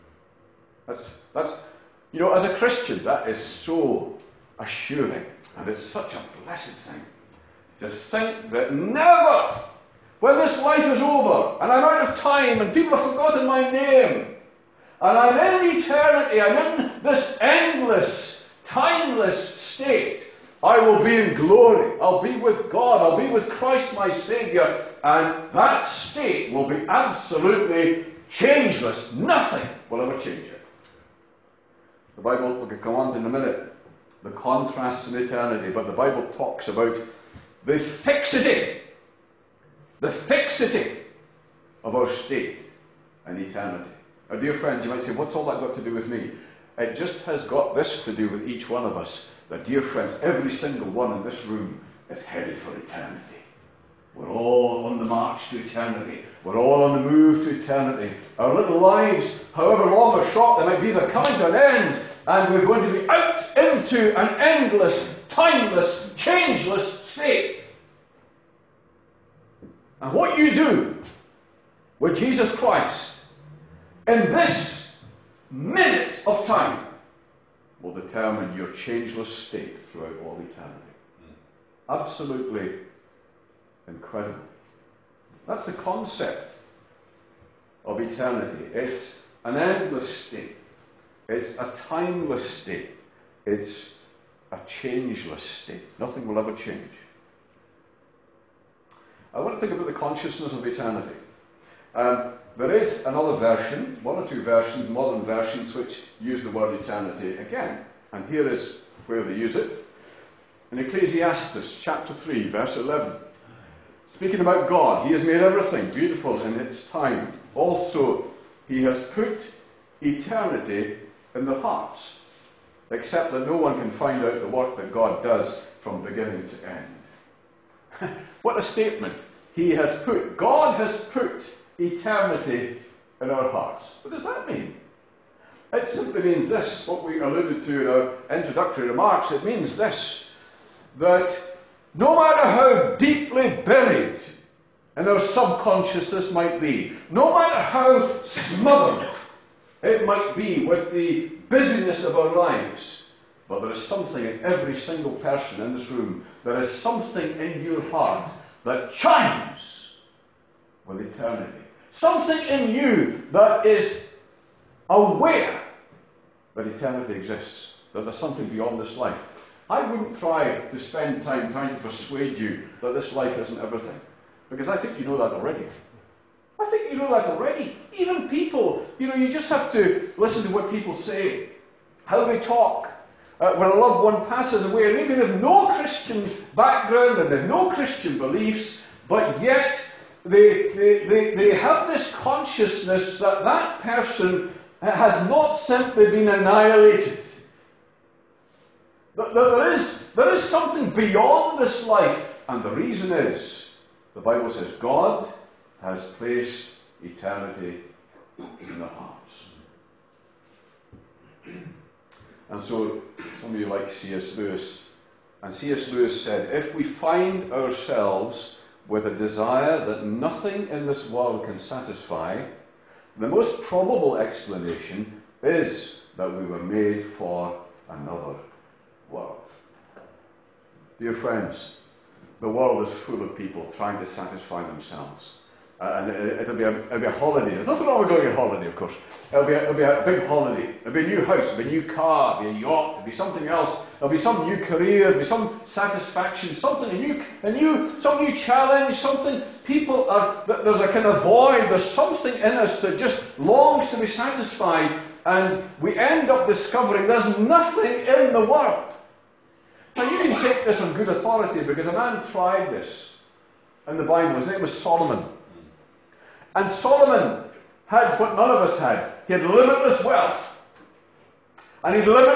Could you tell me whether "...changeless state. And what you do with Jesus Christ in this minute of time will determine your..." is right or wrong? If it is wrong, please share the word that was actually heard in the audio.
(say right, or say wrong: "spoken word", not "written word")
right.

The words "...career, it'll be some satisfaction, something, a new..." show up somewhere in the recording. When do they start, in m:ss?
4:04.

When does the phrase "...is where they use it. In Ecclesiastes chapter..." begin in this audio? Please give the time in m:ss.
1:48.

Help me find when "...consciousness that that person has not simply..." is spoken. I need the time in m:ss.
3:12.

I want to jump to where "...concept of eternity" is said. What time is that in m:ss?
1:25.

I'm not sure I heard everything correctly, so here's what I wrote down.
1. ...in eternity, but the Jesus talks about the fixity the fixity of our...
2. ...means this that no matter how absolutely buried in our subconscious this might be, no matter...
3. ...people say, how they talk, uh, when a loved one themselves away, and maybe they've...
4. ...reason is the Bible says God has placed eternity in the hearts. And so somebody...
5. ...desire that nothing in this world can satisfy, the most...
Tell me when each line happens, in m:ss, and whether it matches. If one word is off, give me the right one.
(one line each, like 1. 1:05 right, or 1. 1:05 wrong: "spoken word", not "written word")
1. 0:35 wrong: "Bible", not "Jesus"
2. 2:19 wrong: "deeply", not "absolutely"
3. 3:00 wrong: "passes", not "themselves"
4. 3:22 right
5. 3:39 right.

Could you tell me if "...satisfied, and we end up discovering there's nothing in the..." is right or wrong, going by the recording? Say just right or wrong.
right.